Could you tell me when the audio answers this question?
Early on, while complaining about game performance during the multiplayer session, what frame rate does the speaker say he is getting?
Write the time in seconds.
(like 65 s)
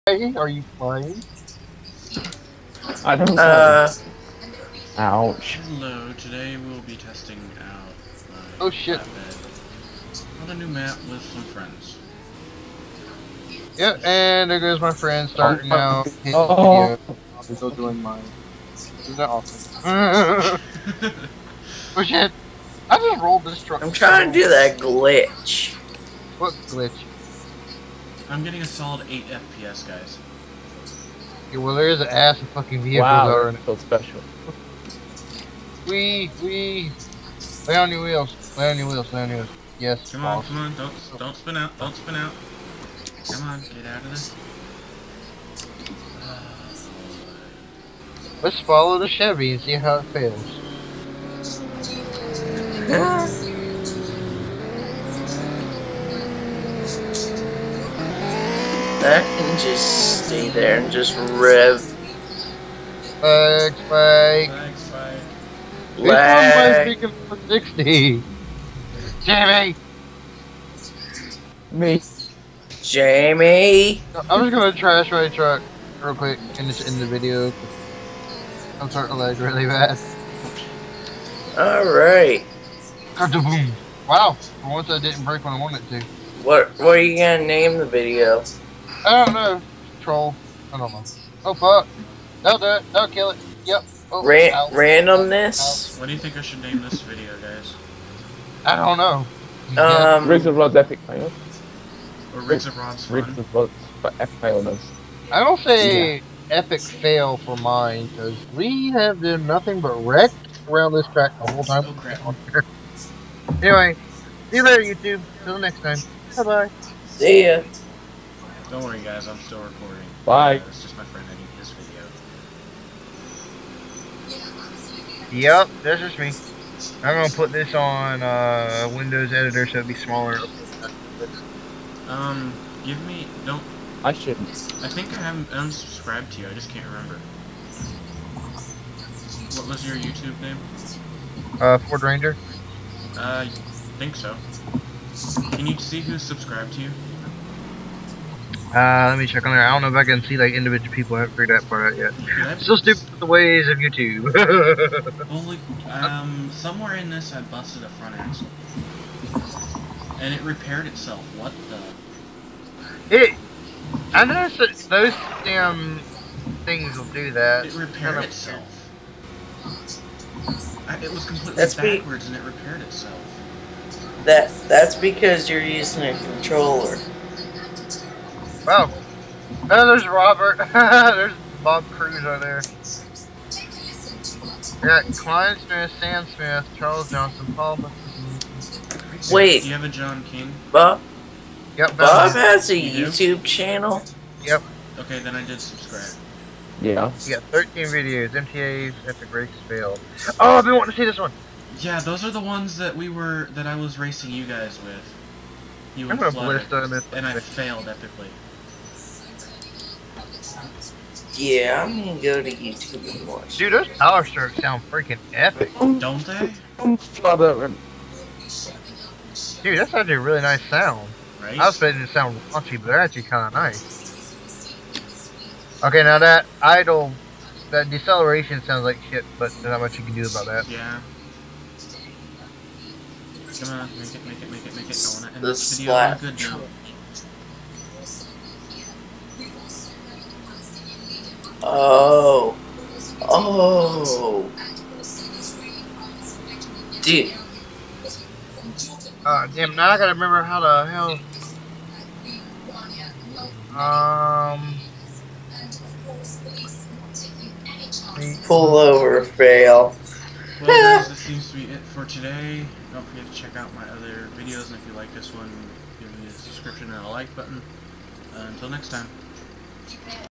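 29 s.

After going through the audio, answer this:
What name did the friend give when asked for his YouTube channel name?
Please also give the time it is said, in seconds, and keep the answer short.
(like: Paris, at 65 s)
Ford Ranger, at 141 s.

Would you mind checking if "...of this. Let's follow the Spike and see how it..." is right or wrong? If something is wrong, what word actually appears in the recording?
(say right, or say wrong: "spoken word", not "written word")
wrong: "Chevy", not "Spike".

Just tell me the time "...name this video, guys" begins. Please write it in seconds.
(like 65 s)
96 s.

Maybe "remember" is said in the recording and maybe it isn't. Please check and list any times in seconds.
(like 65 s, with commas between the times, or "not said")
136 s, 250 s.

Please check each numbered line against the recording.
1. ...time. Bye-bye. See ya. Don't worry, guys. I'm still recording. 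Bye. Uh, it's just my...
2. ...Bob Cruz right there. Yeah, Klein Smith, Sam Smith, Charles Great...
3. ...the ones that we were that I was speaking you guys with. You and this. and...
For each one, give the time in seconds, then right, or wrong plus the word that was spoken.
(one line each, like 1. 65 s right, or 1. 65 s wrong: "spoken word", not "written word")
1. 115 s right
2. 181 s wrong: "Johnson", not "Great"
3. 202 s wrong: "racing", not "speaking".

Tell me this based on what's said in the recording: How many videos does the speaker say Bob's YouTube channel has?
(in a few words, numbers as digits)
13.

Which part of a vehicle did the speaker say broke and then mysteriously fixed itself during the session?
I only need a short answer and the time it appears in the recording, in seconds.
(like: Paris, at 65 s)
front axle, at 157 s.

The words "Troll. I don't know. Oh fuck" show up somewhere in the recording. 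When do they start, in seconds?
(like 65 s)
90 s.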